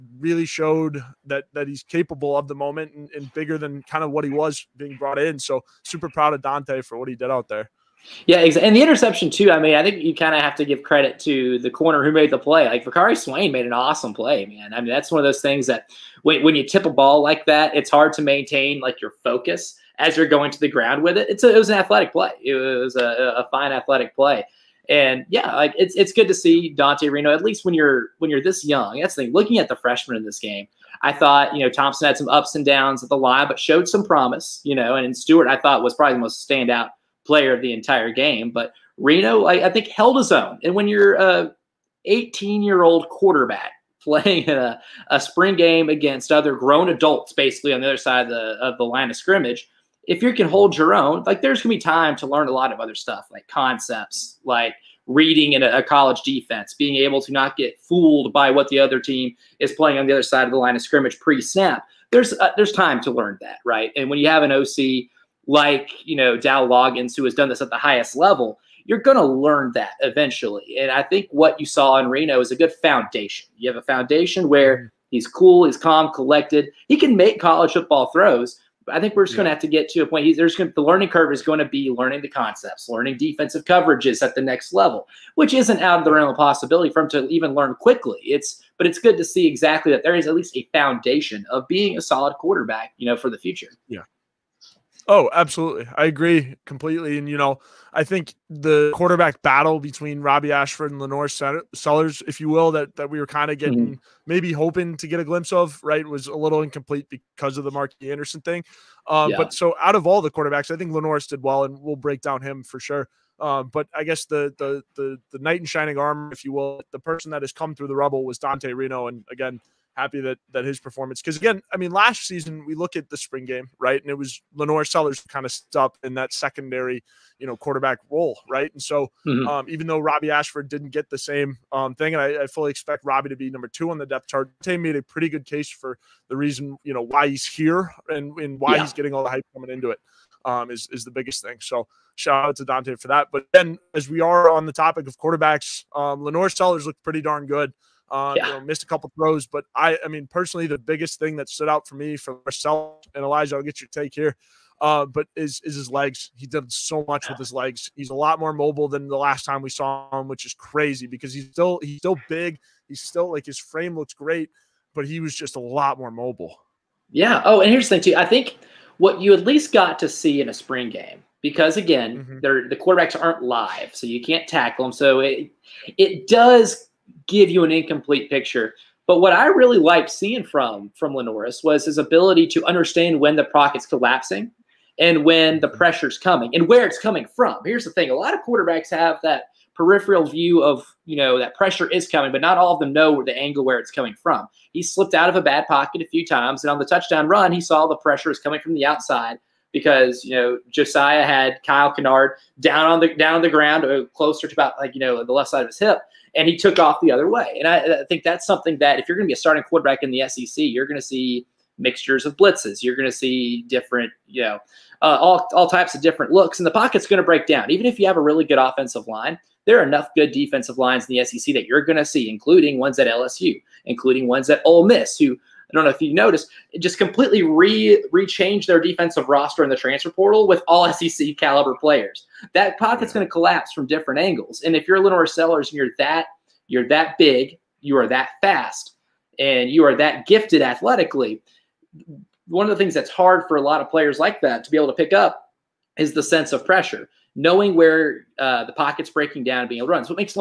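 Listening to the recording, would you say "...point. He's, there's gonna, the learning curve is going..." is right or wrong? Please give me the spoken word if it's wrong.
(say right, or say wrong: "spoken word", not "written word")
right.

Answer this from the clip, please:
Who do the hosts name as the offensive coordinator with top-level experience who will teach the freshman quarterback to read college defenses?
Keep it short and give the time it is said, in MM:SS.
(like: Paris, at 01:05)
Dow Loggins, at 01:06.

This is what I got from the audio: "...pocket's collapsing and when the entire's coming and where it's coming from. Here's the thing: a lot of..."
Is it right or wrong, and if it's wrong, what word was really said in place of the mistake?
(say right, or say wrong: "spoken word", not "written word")
wrong: "pressure", not "entire".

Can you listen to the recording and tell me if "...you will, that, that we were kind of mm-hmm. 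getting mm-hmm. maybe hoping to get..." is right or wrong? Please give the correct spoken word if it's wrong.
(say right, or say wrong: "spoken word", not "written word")
right.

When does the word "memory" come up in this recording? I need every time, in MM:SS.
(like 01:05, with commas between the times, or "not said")
not said.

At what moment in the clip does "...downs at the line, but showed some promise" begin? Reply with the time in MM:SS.
00:32.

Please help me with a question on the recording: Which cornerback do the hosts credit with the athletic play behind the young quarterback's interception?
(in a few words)
Vicari Swain.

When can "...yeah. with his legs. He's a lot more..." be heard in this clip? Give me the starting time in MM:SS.
02:37.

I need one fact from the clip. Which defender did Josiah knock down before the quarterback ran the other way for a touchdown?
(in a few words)
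Kyle Kennard.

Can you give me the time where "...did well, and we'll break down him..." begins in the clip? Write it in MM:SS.
01:51.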